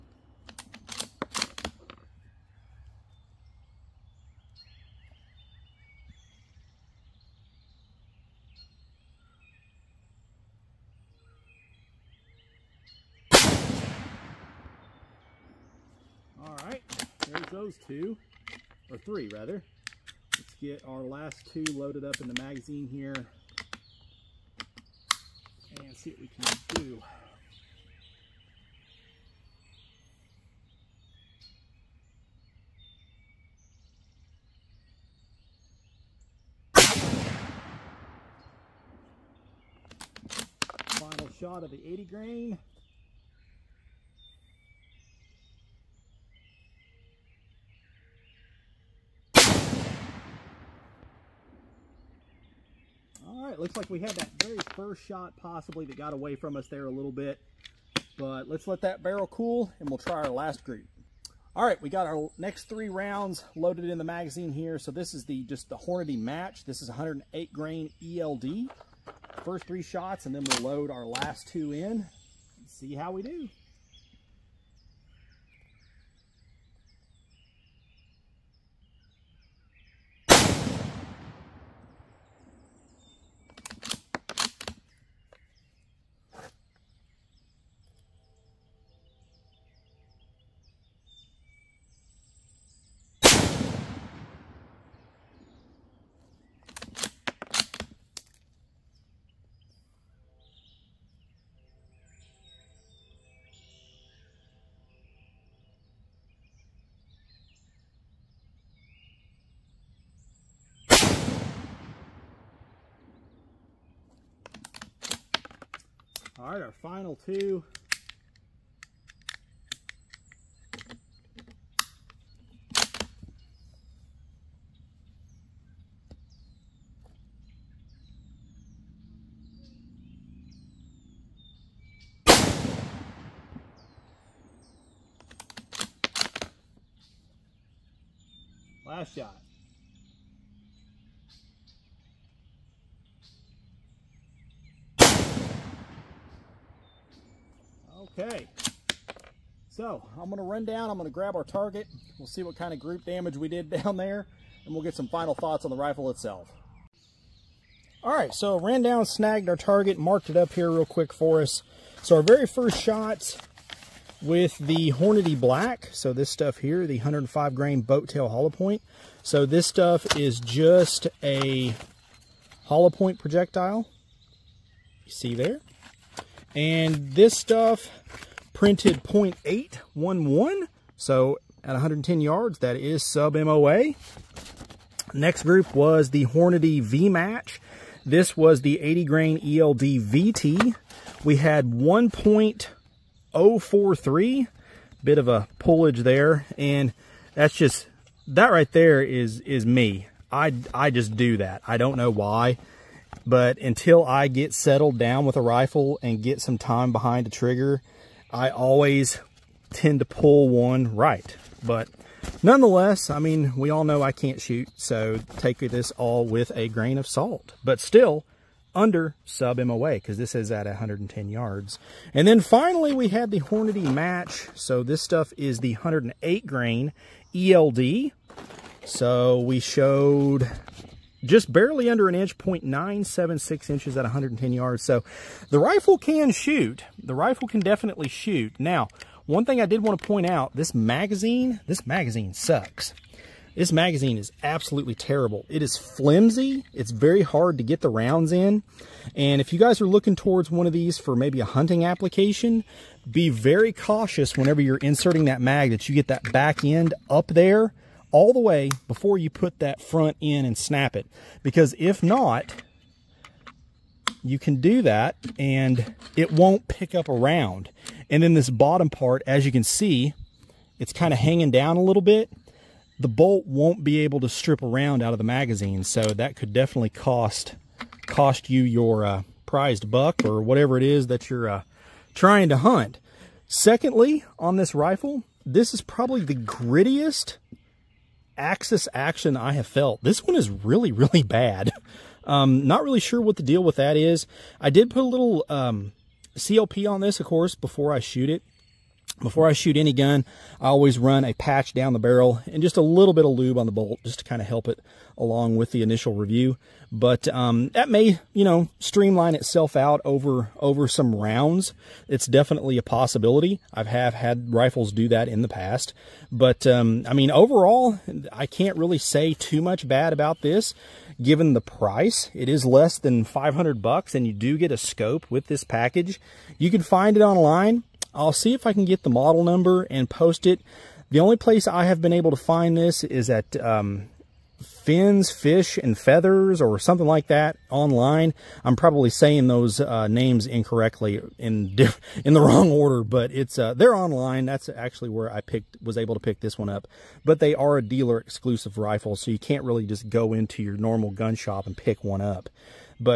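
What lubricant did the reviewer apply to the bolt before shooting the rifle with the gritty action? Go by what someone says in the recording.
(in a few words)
CLP.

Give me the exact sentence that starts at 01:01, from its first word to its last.
All right, we got our next three rounds loaded in the magazine here.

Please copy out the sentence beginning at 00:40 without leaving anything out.
Final shot of the 80 grain.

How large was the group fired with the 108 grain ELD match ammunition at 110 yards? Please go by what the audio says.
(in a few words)
0.976 inches.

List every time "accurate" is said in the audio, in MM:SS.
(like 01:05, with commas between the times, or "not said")
not said.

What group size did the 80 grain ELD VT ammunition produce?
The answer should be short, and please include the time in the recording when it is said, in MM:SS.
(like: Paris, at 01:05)
1.043, at 03:11.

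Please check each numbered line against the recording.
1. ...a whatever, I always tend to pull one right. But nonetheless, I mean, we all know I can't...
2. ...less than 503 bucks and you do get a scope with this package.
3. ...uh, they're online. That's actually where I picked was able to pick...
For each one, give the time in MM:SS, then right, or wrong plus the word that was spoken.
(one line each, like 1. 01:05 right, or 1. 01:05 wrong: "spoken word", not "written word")
1. 03:27 wrong: "trigger", not "whatever"
2. 05:22 wrong: "500", not "503"
3. 05:43 right.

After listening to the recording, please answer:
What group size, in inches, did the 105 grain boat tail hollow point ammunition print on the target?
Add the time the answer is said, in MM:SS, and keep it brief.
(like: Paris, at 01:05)
0.811, at 02:59.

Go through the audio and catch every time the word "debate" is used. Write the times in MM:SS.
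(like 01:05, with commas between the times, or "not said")
not said.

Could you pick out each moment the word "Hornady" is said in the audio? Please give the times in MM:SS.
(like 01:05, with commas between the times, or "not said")
01:05, 02:44, 03:06, 03:43.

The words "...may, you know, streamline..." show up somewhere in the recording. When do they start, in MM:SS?
05:07.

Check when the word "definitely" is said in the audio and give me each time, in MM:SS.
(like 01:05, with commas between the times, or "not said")
03:57, 04:36, 05:12.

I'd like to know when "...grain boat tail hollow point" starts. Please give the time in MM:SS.
02:47.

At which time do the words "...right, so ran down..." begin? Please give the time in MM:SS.
02:38.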